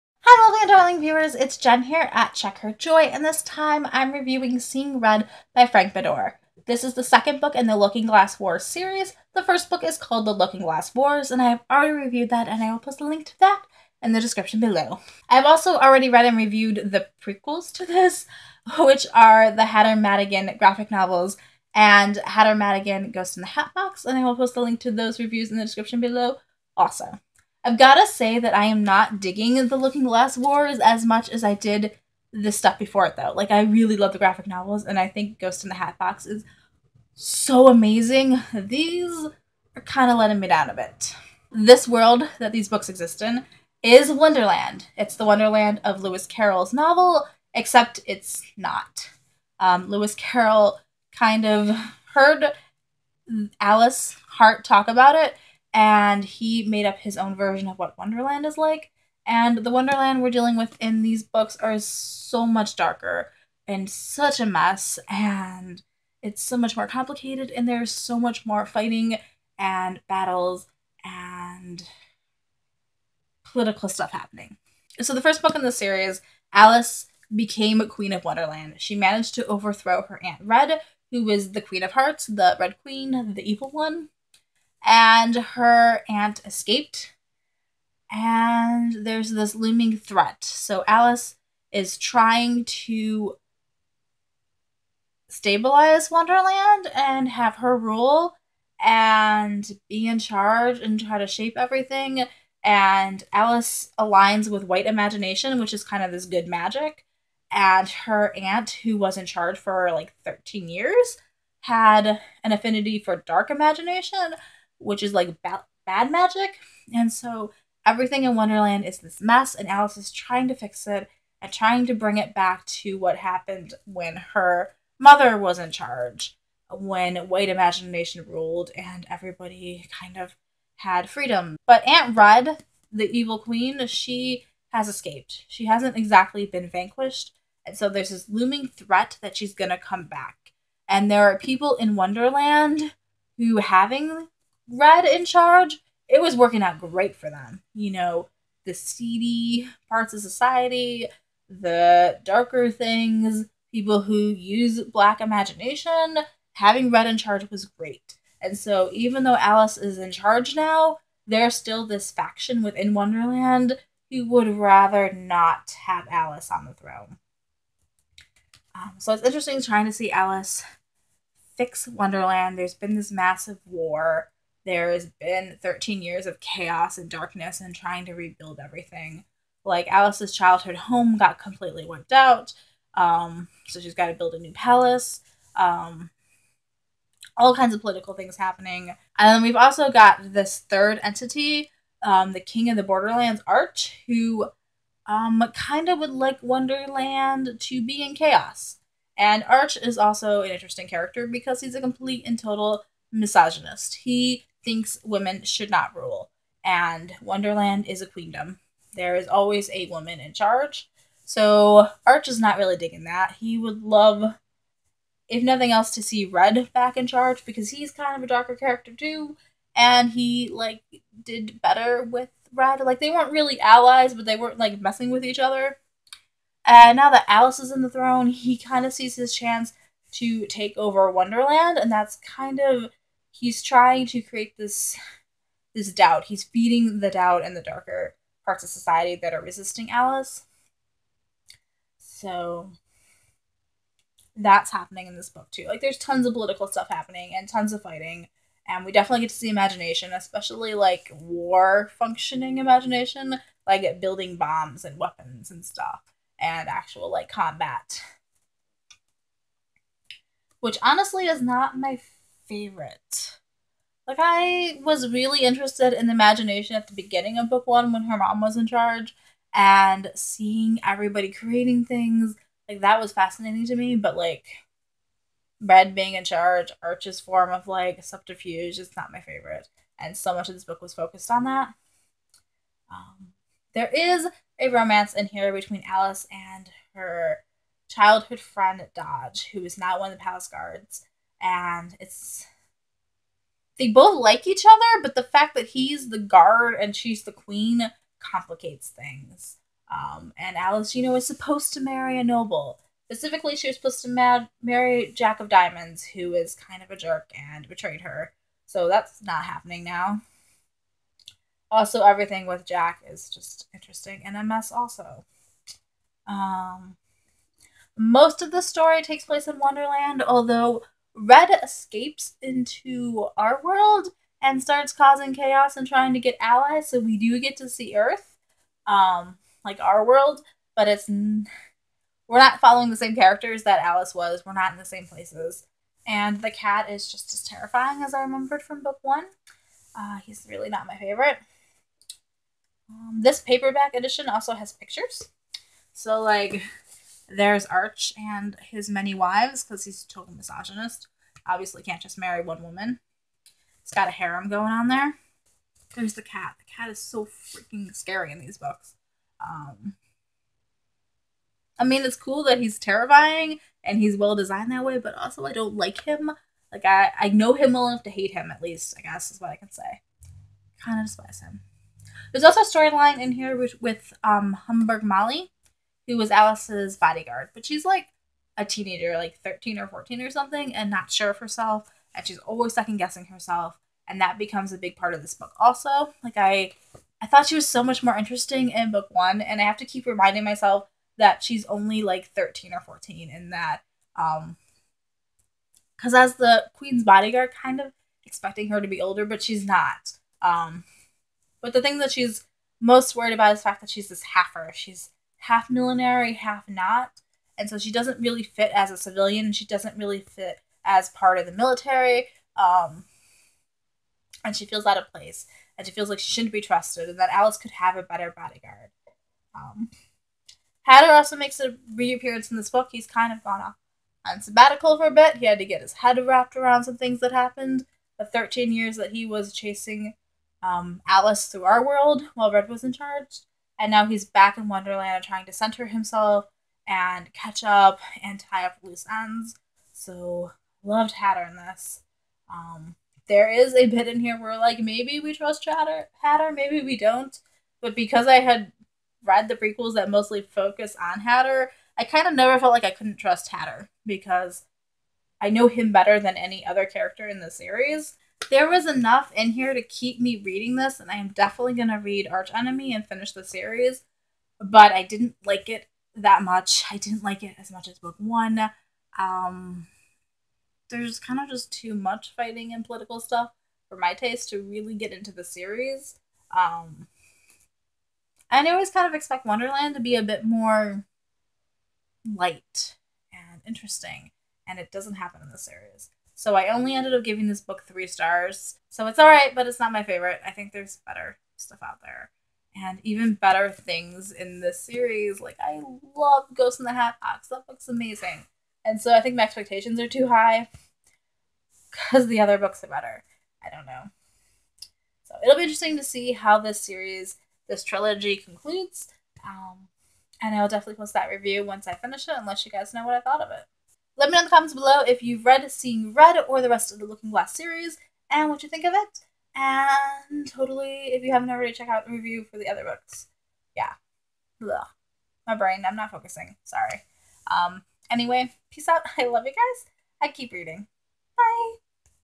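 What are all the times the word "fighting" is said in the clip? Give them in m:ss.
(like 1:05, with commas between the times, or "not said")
1:08, 4:07, 7:52.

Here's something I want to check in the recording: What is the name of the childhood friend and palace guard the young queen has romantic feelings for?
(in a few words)
Dodge.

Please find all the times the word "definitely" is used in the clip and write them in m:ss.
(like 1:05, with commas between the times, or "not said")
4:08, 7:41, 8:30.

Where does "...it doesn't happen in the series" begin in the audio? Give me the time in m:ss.
8:04.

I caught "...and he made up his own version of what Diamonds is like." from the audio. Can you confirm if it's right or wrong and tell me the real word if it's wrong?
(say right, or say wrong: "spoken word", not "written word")
wrong: "Wonderland", not "Diamonds".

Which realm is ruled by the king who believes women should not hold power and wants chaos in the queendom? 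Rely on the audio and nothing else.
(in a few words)
the Borderlands.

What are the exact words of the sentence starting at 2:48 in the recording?
Um, so, it's interesting trying to see Alyss fix Wonderland.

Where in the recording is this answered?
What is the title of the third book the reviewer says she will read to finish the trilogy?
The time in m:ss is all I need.
7:42.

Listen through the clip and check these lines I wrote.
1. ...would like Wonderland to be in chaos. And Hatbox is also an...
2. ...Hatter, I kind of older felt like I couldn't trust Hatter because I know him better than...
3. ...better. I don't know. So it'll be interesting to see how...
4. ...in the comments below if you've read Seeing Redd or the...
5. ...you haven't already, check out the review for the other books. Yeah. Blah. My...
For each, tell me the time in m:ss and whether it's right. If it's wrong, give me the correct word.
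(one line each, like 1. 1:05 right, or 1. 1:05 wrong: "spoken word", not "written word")
1. 3:15 wrong: "Arch", not "Hatbox"
2. 7:31 wrong: "never", not "older"
3. 8:22 right
4. 8:34 right
5. 8:41 right.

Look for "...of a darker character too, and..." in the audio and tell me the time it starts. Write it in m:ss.
3:38.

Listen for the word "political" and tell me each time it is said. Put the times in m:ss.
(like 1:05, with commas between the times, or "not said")
1:13, 3:07, 4:06, 7:52.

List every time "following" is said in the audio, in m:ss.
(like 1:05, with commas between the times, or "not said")
5:32.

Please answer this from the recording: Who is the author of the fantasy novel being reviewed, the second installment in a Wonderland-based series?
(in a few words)
Frank Beddor.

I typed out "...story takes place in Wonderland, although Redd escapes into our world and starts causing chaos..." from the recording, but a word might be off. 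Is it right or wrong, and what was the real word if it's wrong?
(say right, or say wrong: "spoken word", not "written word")
right.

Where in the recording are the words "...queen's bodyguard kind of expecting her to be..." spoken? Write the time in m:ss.
6:36.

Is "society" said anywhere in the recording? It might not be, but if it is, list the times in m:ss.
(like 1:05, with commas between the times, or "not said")
2:30, 3:58.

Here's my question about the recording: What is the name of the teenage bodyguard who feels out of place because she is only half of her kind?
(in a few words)
Homburg Molly.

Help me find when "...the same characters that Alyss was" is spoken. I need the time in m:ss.
5:32.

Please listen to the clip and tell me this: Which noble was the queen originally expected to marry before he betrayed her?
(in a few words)
Jack of Diamonds.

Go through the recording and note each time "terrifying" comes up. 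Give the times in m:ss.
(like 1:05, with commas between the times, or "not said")
5:37, 6:02.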